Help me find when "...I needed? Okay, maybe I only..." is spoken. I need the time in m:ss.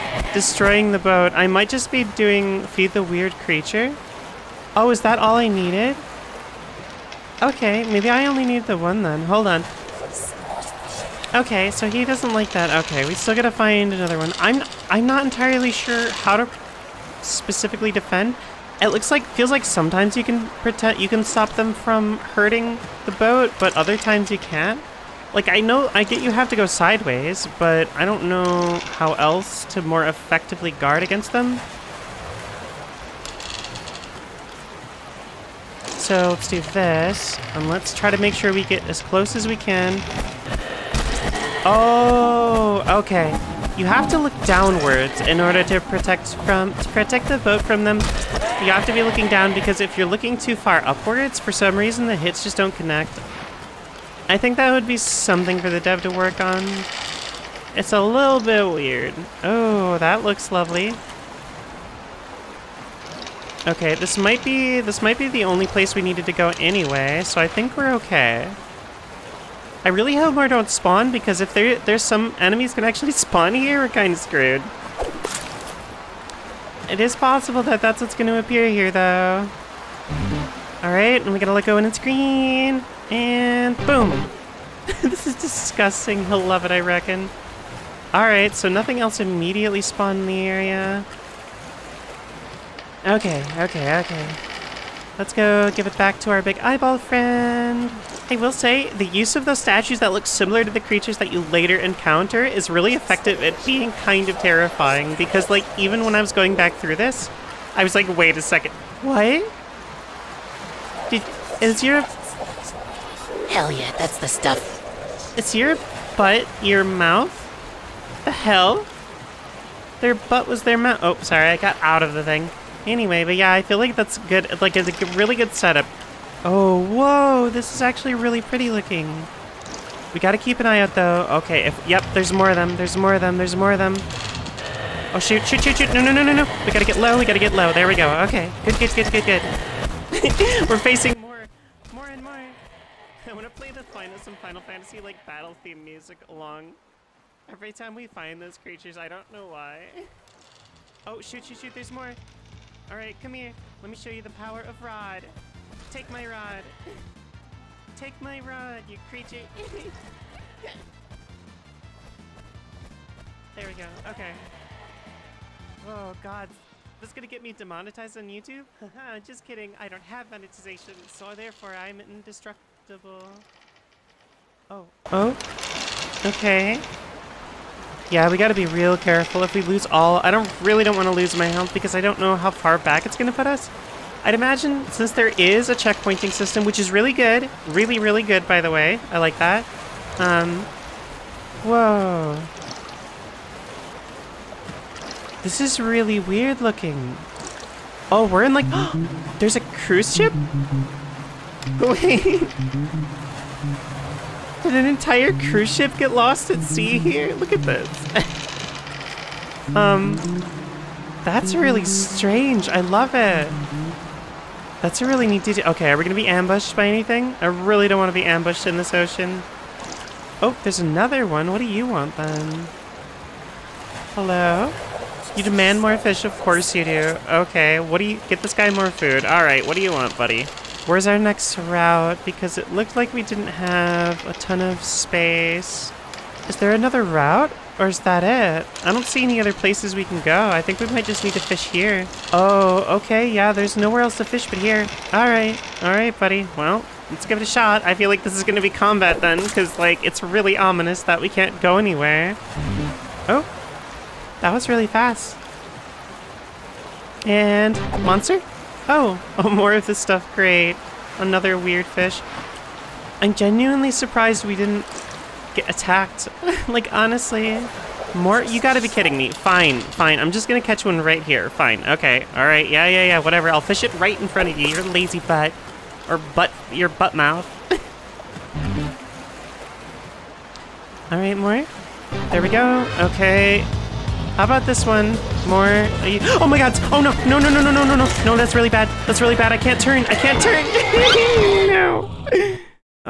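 0:05.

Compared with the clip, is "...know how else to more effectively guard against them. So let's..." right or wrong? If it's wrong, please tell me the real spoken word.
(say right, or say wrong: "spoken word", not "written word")
right.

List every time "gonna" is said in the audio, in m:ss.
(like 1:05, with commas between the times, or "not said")
2:47, 3:03, 3:36, 4:30.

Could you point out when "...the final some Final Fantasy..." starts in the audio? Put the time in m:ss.
2:23.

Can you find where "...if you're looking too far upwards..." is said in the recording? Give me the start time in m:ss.
0:49.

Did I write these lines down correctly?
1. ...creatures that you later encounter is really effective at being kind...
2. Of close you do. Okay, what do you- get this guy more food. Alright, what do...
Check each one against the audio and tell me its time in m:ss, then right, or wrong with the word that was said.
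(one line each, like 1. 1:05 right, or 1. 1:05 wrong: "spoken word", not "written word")
1. 1:40 right
2. 3:46 wrong: "course", not "close".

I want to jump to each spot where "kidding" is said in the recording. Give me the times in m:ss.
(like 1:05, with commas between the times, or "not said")
2:49, 4:28.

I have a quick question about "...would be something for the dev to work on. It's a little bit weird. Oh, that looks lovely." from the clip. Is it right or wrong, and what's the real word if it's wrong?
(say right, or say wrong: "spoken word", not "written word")
right.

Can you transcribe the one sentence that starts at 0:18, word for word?
It looks like feels like sometimes you can pretend you can stop them from hurting the boat, but other times you can't.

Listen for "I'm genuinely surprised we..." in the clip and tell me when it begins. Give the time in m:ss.
4:23.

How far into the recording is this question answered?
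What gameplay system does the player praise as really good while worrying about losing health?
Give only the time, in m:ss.
3:05.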